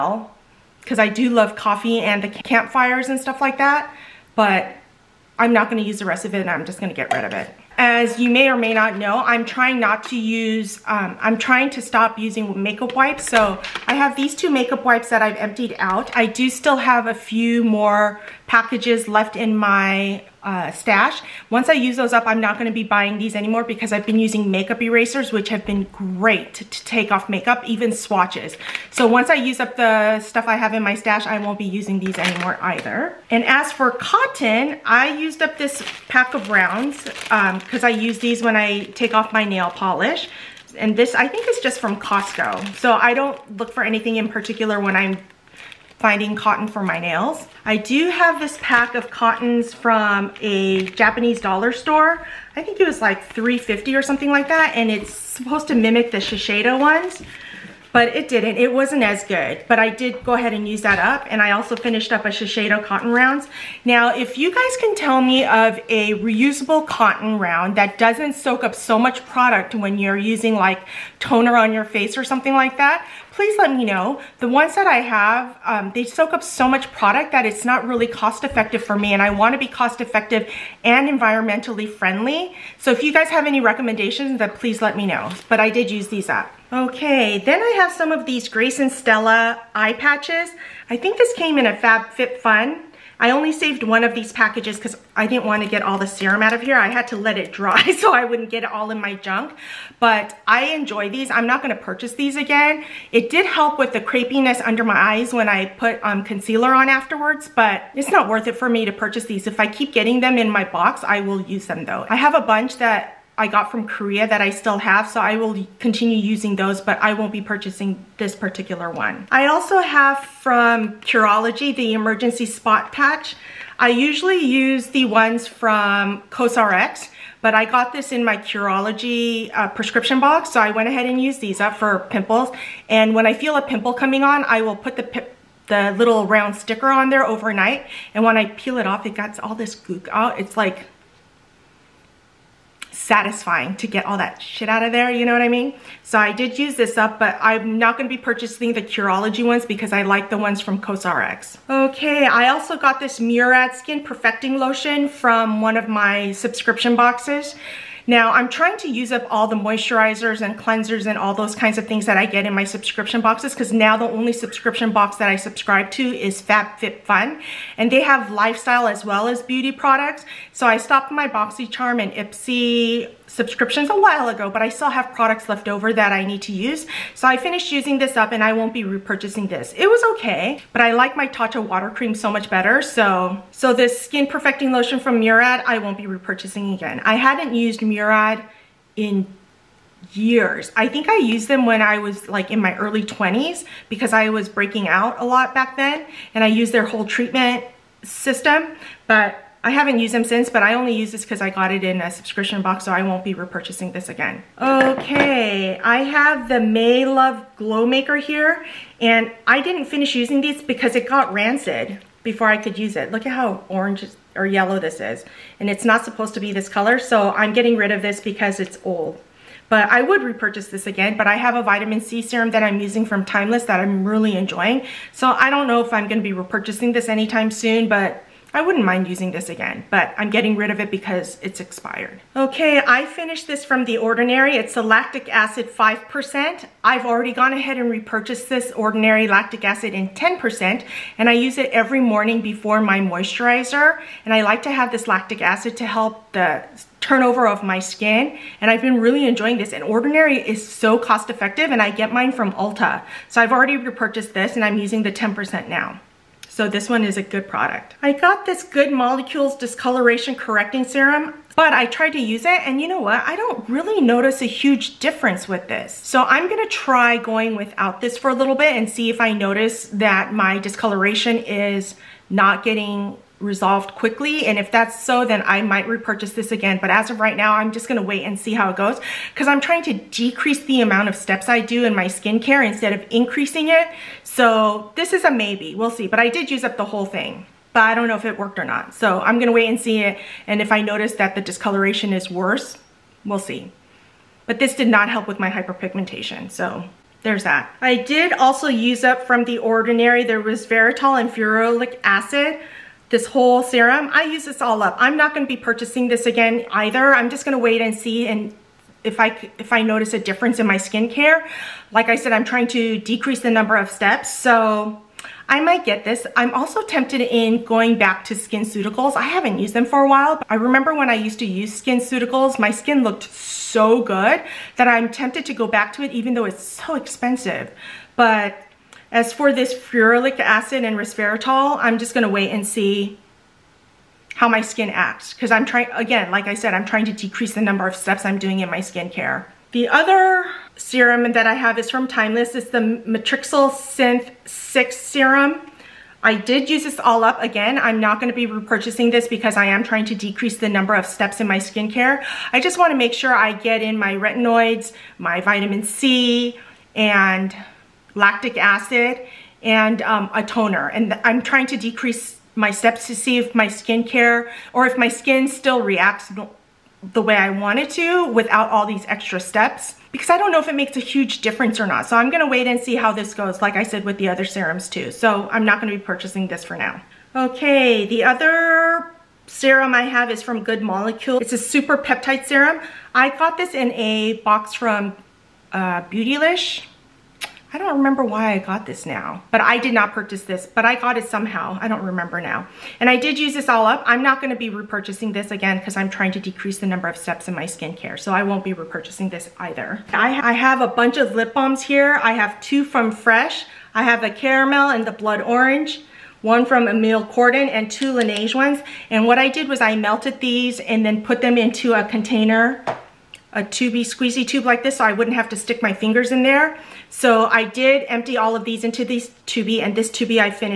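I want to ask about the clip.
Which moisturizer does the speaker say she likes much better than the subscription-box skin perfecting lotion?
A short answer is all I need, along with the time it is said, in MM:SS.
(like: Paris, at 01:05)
Tatcha water cream, at 03:01.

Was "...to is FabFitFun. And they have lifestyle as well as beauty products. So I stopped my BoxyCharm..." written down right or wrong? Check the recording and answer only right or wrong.
right.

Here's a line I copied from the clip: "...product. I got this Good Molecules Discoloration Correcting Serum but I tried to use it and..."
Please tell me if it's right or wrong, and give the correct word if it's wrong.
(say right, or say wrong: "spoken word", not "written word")
right.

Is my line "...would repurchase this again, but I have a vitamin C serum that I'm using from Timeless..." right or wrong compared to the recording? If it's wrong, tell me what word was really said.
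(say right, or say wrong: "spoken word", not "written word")
right.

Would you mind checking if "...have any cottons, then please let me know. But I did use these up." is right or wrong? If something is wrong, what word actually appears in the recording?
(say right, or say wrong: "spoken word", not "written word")
wrong: "recommendations", not "cottons".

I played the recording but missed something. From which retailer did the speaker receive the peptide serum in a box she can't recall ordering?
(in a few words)
Beautylish.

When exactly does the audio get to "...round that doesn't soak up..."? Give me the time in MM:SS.
01:07.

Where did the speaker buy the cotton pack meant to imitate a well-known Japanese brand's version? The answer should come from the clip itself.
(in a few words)
Japanese dollar store.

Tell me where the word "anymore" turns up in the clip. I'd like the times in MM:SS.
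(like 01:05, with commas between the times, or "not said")
00:23, 00:32.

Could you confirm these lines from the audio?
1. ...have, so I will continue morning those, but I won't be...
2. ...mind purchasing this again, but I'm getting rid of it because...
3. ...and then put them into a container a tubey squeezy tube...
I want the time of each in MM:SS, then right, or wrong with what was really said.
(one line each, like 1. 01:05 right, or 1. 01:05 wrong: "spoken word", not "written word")
1. 01:54 wrong: "using", not "morning"
2. 03:48 wrong: "using", not "purchasing"
3. 06:50 right.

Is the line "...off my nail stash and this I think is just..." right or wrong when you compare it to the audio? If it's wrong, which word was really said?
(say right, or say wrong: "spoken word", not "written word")
wrong: "polish", not "stash".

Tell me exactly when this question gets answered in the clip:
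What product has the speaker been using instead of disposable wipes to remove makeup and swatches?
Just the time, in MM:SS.
00:24.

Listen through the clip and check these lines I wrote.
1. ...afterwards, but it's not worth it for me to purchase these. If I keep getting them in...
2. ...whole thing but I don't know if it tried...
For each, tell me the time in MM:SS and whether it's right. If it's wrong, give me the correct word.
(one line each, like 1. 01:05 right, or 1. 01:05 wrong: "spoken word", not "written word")
1. 01:46 right
2. 04:46 wrong: "worked", not "tried".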